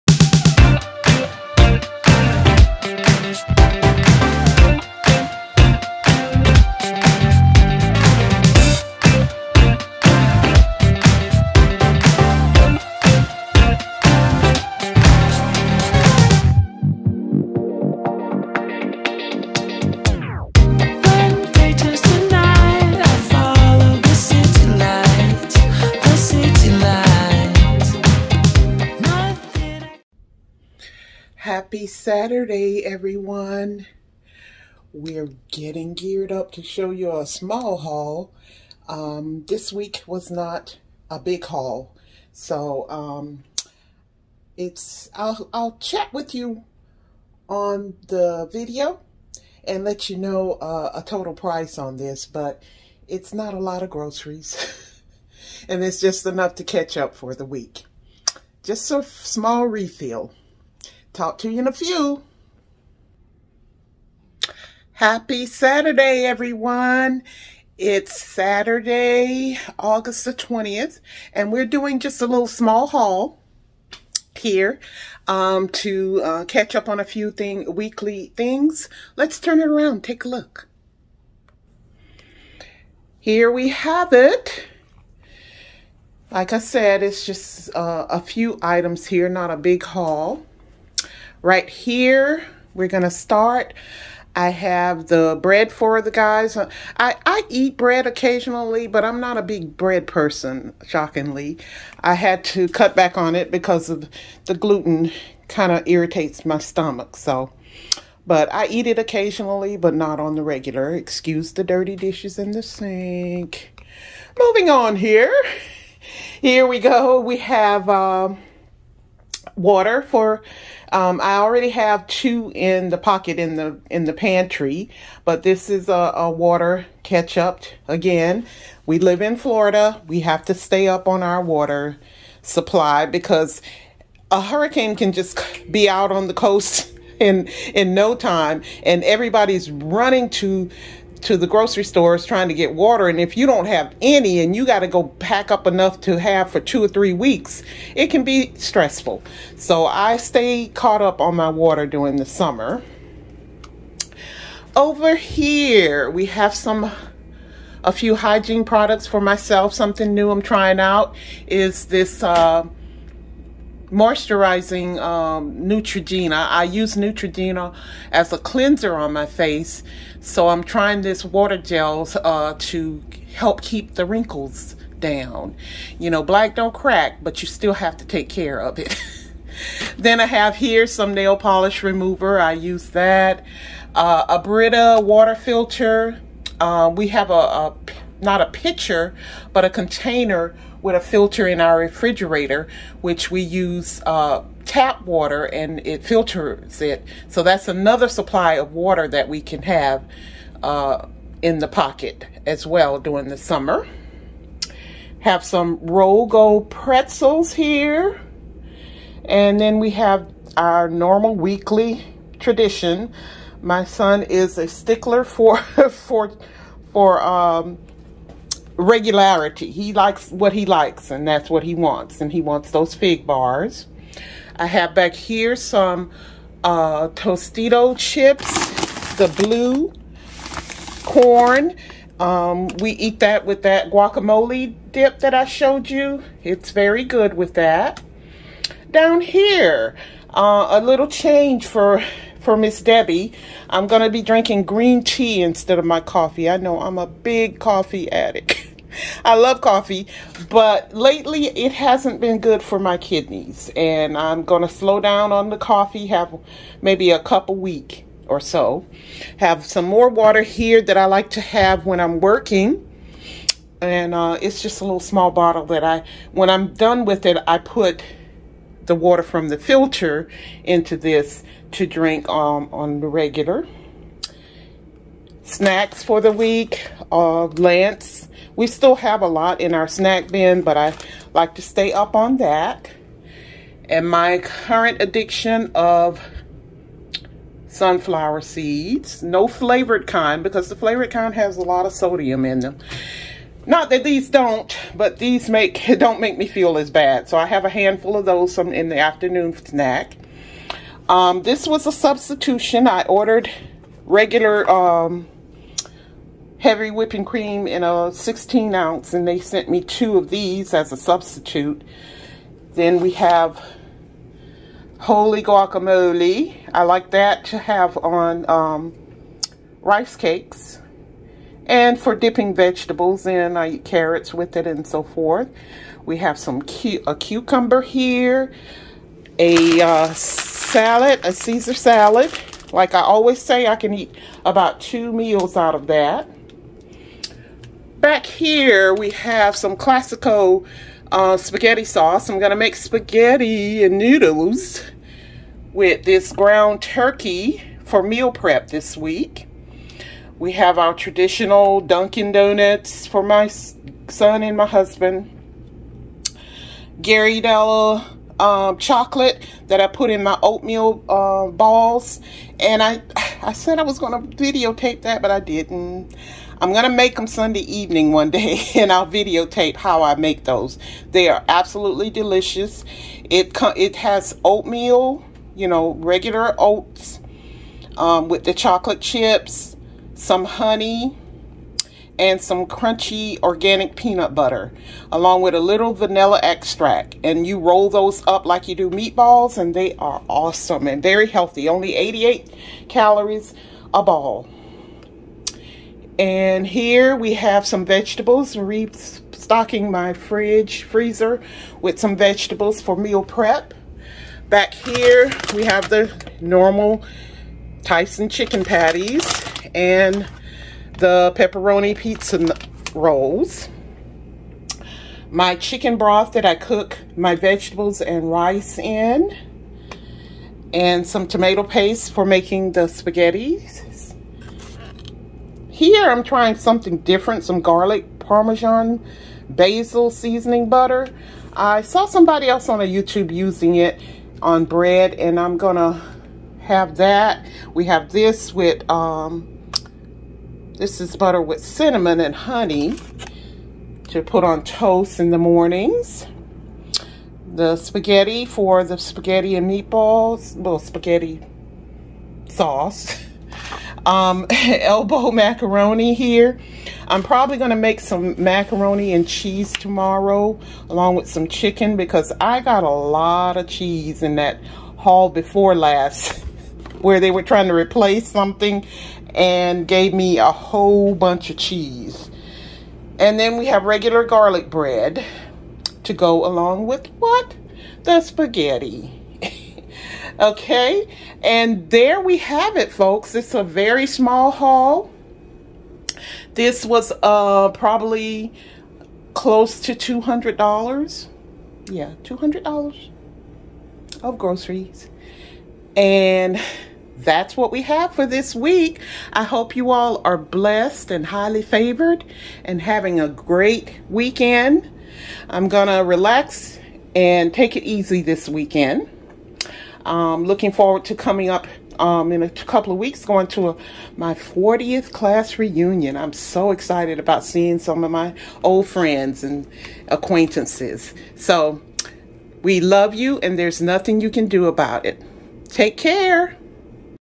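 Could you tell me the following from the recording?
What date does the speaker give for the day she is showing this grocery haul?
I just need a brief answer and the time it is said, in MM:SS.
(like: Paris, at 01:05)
August 20, at 01:09.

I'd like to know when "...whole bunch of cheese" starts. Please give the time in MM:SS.
07:50.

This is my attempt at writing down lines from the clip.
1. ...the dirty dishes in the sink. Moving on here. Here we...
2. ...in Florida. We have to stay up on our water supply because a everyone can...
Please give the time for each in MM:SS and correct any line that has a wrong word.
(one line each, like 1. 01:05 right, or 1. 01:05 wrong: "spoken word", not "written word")
1. 01:51 right
2. 02:09 wrong: "hurricane", not "everyone".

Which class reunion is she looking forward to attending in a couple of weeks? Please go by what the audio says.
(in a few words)
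40th.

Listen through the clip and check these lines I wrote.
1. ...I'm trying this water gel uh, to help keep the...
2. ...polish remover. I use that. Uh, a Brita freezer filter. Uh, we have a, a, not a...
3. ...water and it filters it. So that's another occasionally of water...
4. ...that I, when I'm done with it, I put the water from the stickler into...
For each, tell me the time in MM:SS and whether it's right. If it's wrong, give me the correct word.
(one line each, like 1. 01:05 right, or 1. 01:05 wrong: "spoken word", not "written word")
1. 02:50 right
2. 03:01 wrong: "water", not "freezer"
3. 03:15 wrong: "supply", not "occasionally"
4. 04:25 wrong: "filter", not "stickler".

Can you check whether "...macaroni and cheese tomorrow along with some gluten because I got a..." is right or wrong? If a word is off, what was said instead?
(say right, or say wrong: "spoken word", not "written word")
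wrong: "chicken", not "gluten".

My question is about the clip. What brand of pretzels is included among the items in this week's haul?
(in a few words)
Rold Gold.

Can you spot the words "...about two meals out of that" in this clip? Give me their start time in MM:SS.
05:34.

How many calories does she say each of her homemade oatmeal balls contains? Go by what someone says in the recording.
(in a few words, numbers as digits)
88.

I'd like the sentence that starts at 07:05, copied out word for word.
Here I'm trying something different, some garlic parmesan basil seasoning butter.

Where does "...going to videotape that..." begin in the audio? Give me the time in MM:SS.
06:03.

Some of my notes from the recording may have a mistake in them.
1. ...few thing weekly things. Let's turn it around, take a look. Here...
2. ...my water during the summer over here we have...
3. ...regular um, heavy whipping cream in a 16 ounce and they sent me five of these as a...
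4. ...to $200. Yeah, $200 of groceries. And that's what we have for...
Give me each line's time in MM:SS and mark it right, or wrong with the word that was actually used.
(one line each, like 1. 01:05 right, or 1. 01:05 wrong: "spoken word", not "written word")
1. 01:17 right
2. 02:31 right
3. 05:04 wrong: "two", not "five"
4. 08:09 right.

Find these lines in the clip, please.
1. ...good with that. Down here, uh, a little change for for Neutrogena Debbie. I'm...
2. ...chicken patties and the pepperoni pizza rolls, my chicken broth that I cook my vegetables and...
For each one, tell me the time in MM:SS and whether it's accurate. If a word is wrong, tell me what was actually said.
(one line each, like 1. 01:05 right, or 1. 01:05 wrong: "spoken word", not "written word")
1. 03:57 wrong: "Miss", not "Neutrogena"
2. 06:48 right.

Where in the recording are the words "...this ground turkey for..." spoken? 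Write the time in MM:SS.
05:46.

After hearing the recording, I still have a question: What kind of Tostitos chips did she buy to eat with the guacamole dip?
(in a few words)
Blue corn.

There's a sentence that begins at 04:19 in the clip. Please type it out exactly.
Have some more water here that I like to have when I'm working.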